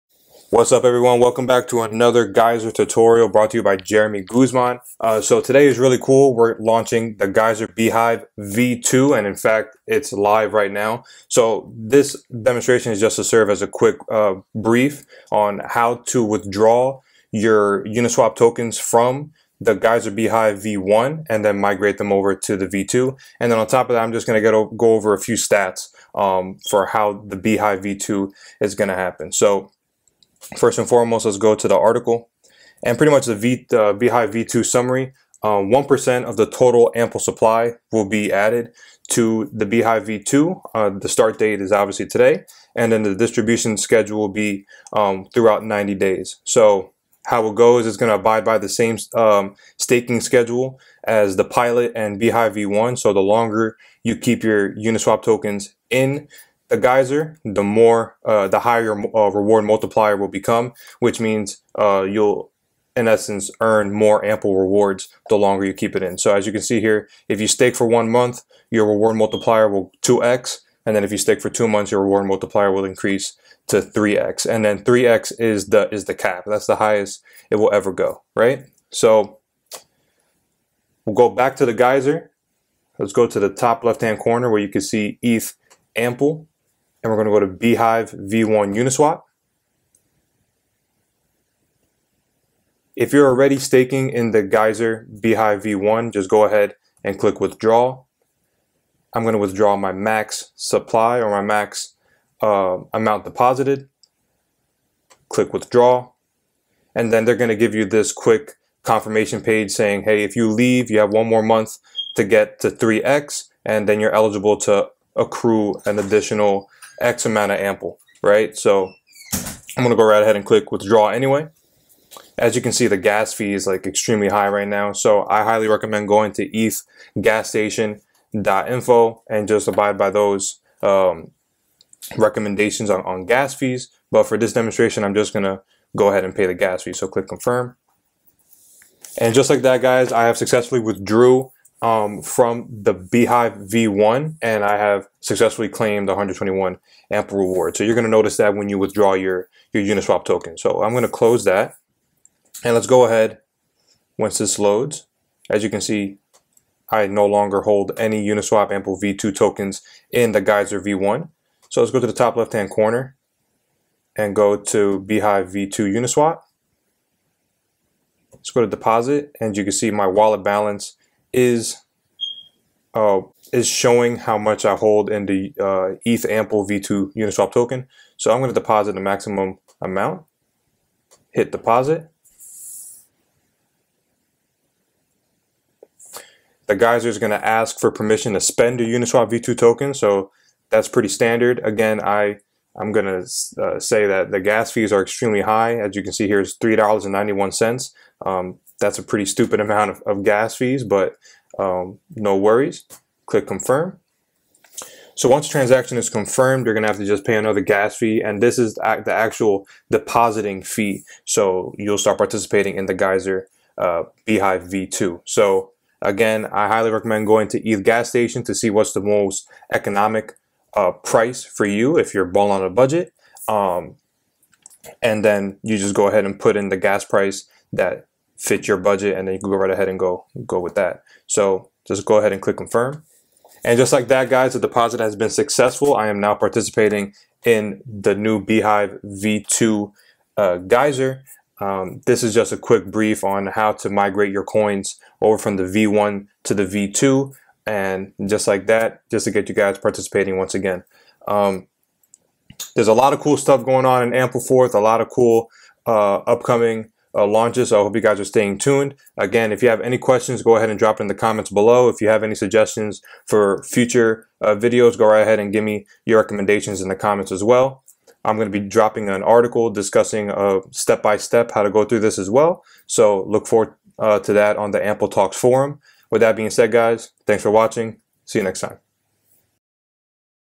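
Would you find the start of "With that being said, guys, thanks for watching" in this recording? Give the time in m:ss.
4:36.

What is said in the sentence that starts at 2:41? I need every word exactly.
So let's go to the top left-hand corner and go to Beehive V2 Uniswap.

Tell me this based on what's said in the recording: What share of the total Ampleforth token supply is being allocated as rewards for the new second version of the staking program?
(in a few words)
1%.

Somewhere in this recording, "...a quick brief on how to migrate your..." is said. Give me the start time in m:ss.
4:02.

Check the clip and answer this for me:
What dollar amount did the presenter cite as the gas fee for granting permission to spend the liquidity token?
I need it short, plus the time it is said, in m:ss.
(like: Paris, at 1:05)
$3.91, at 3:16.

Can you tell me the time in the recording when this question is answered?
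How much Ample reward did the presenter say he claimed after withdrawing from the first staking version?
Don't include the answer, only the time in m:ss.
2:26.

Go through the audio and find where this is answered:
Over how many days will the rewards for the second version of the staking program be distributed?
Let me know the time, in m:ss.
0:45.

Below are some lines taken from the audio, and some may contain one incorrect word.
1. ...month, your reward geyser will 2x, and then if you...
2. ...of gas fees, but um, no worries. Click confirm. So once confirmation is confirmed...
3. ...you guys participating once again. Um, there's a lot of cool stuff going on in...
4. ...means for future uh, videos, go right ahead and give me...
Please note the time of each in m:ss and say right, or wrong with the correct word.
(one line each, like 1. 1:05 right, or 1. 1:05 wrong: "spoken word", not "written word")
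1. 1:08 wrong: "multiplier", not "geyser"
2. 3:20 wrong: "transaction", not "confirmation"
3. 4:09 right
4. 4:22 wrong: "suggestions", not "means".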